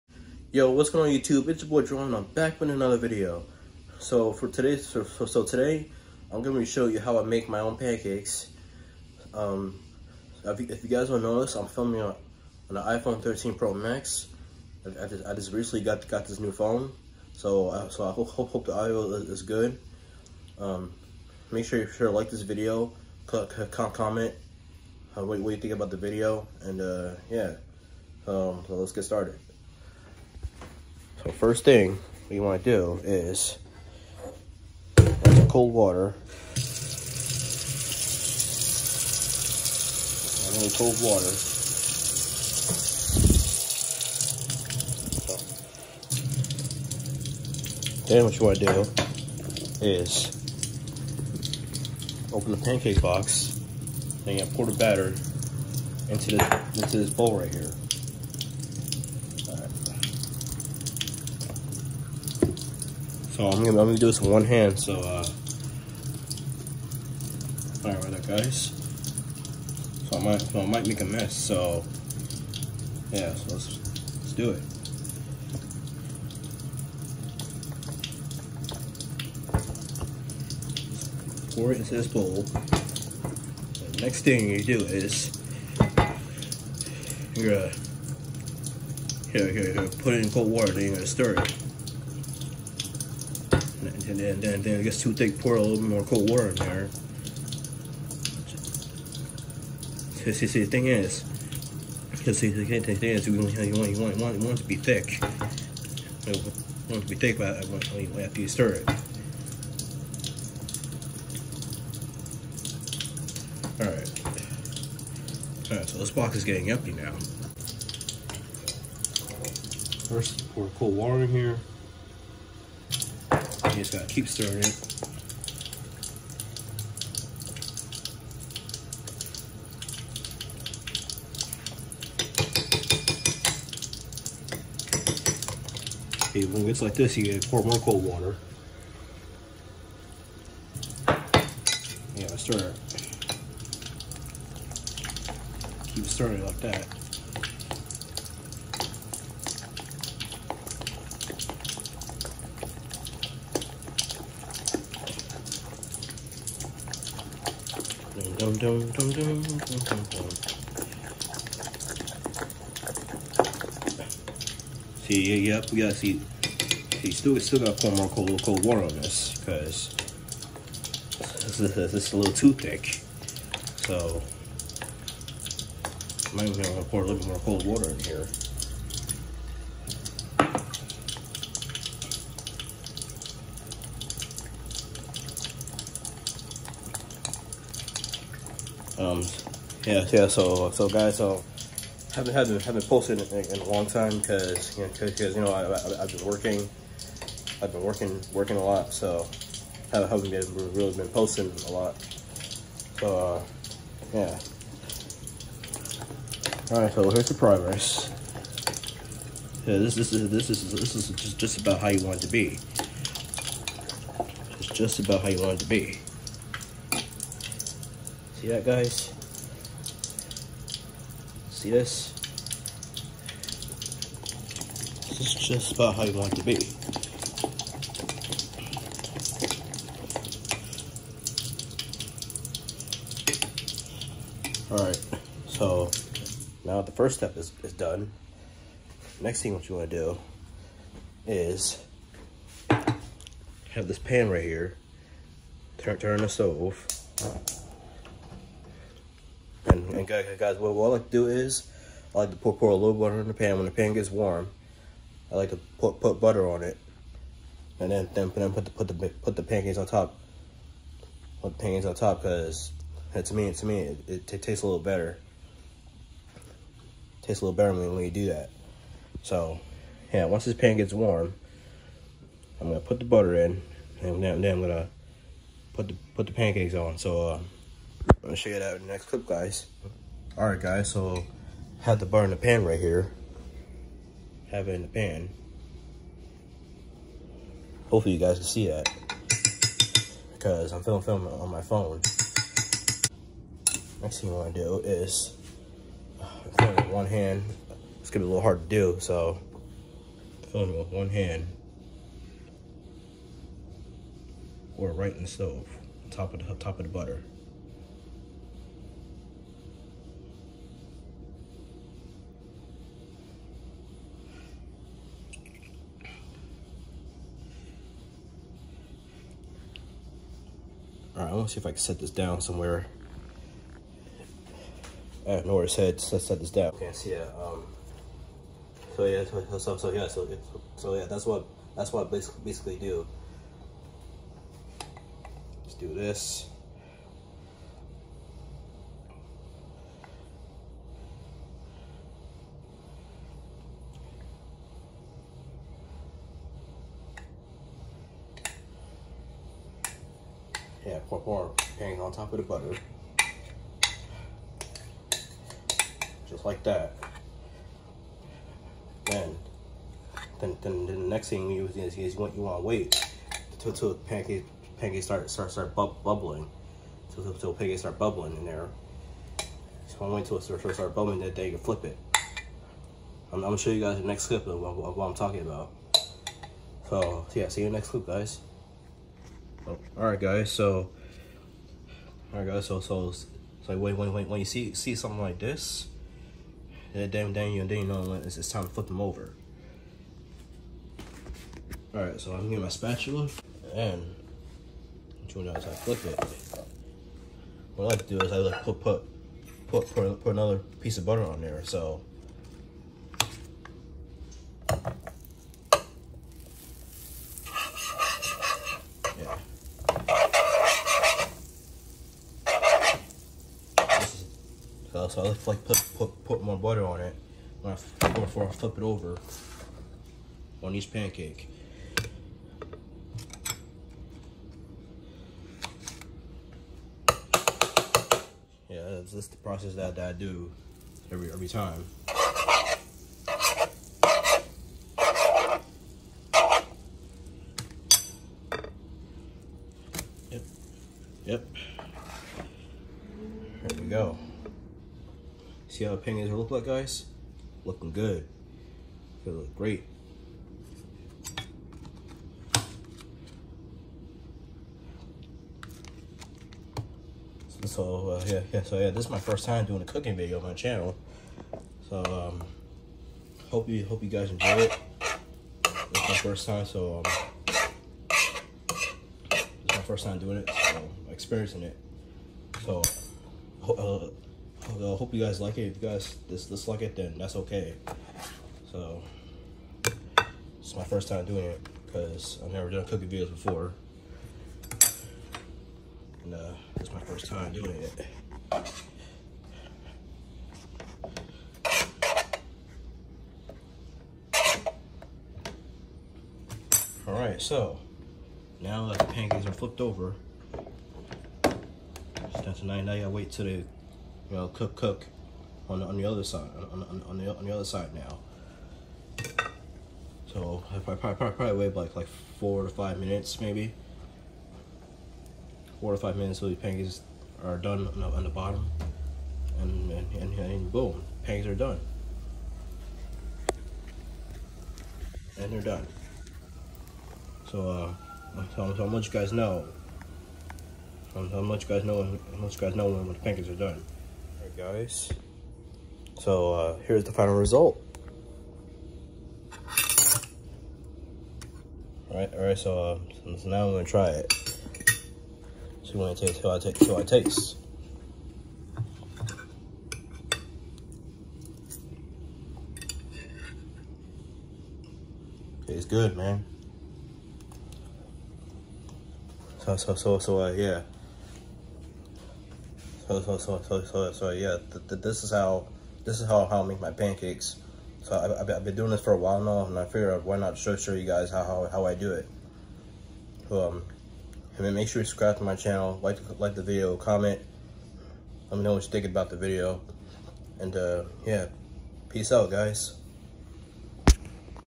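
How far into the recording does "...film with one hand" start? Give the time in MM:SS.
04:56.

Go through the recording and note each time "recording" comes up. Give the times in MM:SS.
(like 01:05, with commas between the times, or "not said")
not said.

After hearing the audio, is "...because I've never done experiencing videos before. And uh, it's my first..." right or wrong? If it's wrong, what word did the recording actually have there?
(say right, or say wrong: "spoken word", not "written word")
wrong: "cooking", not "experiencing".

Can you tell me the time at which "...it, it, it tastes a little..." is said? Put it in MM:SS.
04:23.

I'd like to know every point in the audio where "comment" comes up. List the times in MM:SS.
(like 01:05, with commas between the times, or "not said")
00:23, 09:36.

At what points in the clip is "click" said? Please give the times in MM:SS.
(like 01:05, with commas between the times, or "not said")
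00:23.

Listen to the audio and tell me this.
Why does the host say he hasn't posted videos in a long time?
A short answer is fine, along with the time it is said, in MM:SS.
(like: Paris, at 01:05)
working a lot, at 03:17.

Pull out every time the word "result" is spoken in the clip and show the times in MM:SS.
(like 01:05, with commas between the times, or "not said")
08:57.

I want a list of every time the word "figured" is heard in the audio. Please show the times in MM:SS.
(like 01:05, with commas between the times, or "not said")
09:29.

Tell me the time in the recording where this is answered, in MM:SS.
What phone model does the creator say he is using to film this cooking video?
00:12.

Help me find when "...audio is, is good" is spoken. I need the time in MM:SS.
00:18.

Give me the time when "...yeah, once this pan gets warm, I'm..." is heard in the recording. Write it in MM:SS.
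04:30.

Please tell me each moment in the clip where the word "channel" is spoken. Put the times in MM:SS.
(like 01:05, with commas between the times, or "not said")
07:40, 09:35.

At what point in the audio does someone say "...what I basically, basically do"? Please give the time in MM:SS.
05:31.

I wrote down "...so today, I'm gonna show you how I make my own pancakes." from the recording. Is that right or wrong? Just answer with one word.
right.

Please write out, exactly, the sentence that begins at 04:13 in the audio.
When the pan gets warm, I like to put, put butter on it.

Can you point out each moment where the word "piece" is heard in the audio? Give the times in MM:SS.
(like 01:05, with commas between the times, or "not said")
06:40.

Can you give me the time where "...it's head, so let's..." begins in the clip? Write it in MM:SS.
05:25.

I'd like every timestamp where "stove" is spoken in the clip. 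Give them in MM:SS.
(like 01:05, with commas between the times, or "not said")
04:06, 05:05.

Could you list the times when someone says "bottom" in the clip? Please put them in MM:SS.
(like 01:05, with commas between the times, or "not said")
08:38.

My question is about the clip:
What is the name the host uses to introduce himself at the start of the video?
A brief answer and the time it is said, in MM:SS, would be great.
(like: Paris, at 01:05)
Jerome, at 00:01.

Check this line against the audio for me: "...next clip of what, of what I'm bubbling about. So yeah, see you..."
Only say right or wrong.
wrong.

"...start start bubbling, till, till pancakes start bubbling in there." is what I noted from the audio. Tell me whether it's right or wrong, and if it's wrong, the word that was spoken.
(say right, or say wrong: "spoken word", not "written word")
right.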